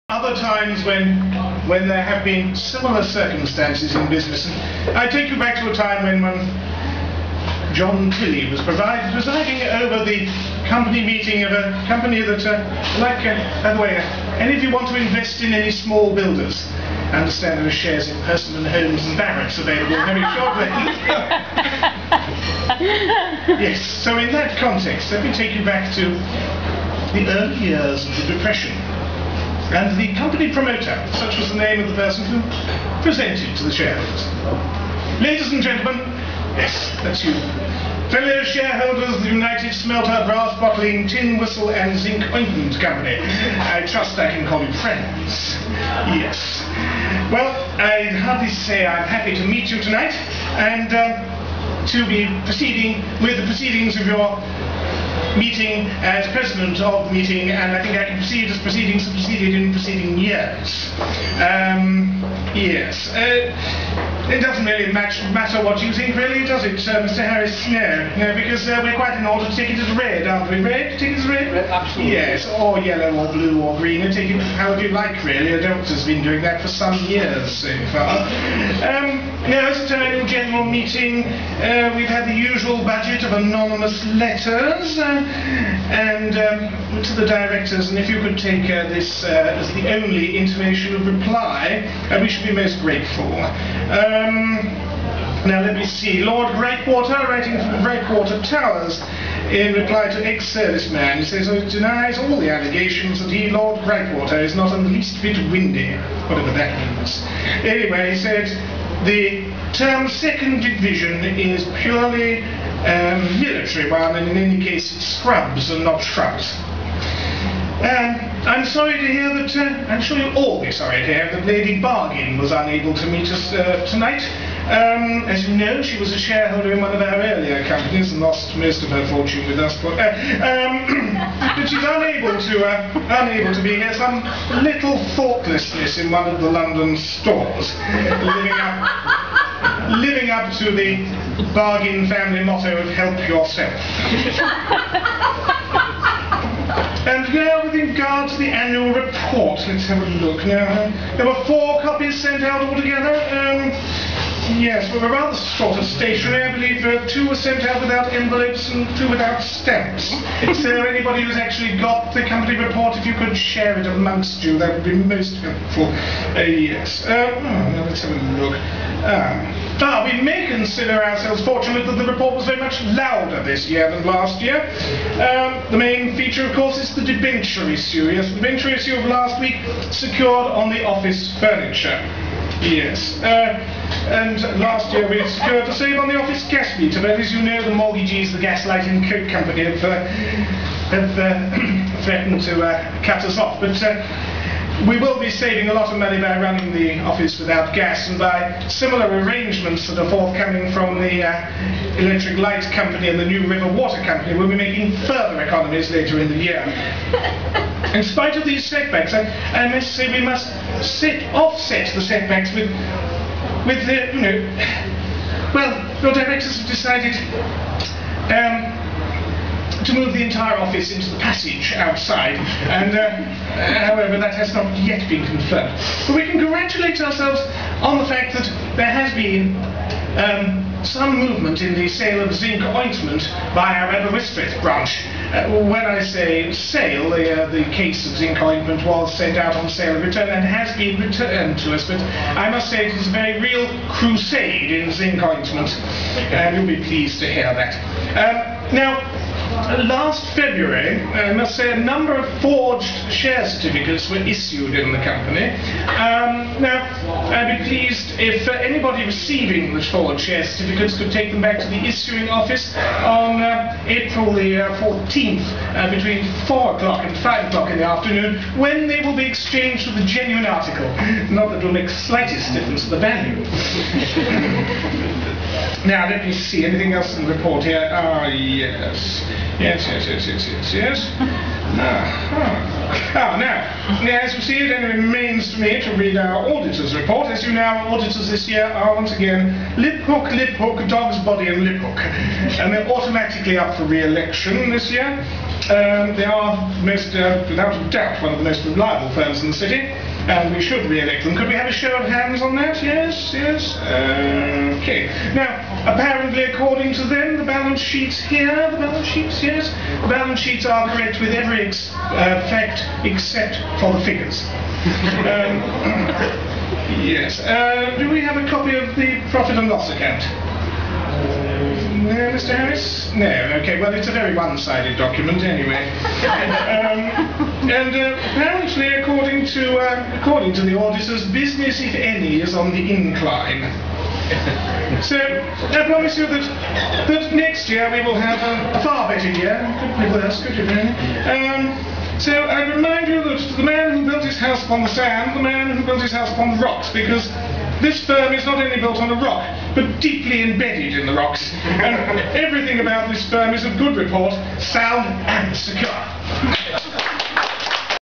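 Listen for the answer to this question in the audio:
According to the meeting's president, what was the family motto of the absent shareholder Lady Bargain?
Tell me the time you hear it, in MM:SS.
02:22.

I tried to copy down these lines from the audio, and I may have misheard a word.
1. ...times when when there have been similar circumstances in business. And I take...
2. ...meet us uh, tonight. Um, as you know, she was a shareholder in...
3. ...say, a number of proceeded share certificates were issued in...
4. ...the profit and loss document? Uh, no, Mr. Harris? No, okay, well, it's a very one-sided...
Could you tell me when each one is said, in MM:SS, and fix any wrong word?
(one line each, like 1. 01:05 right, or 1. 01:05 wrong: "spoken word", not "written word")
1. 00:00 right
2. 02:03 right
3. 04:11 wrong: "forged", not "proceeded"
4. 05:18 wrong: "account", not "document".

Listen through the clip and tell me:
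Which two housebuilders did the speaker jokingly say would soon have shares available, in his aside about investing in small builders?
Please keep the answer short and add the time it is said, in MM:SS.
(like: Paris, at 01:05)
Persimmon Homes and Barratts, at 00:18.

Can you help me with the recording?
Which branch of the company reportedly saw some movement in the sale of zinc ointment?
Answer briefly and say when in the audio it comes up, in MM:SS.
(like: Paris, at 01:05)
Aberystwyth, at 03:53.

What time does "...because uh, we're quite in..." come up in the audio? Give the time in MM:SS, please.
01:08.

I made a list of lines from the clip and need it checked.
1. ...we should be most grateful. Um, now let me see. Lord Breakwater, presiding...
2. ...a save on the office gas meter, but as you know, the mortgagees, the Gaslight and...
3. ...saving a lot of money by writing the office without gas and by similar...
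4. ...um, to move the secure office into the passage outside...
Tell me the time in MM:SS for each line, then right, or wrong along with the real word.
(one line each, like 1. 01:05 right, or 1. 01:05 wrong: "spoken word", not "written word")
1. 01:32 wrong: "writing", not "presiding"
2. 03:05 right
3. 03:15 wrong: "running", not "writing"
4. 03:38 wrong: "entire", not "secure".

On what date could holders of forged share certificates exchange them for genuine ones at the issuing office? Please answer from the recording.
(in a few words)
April 14th.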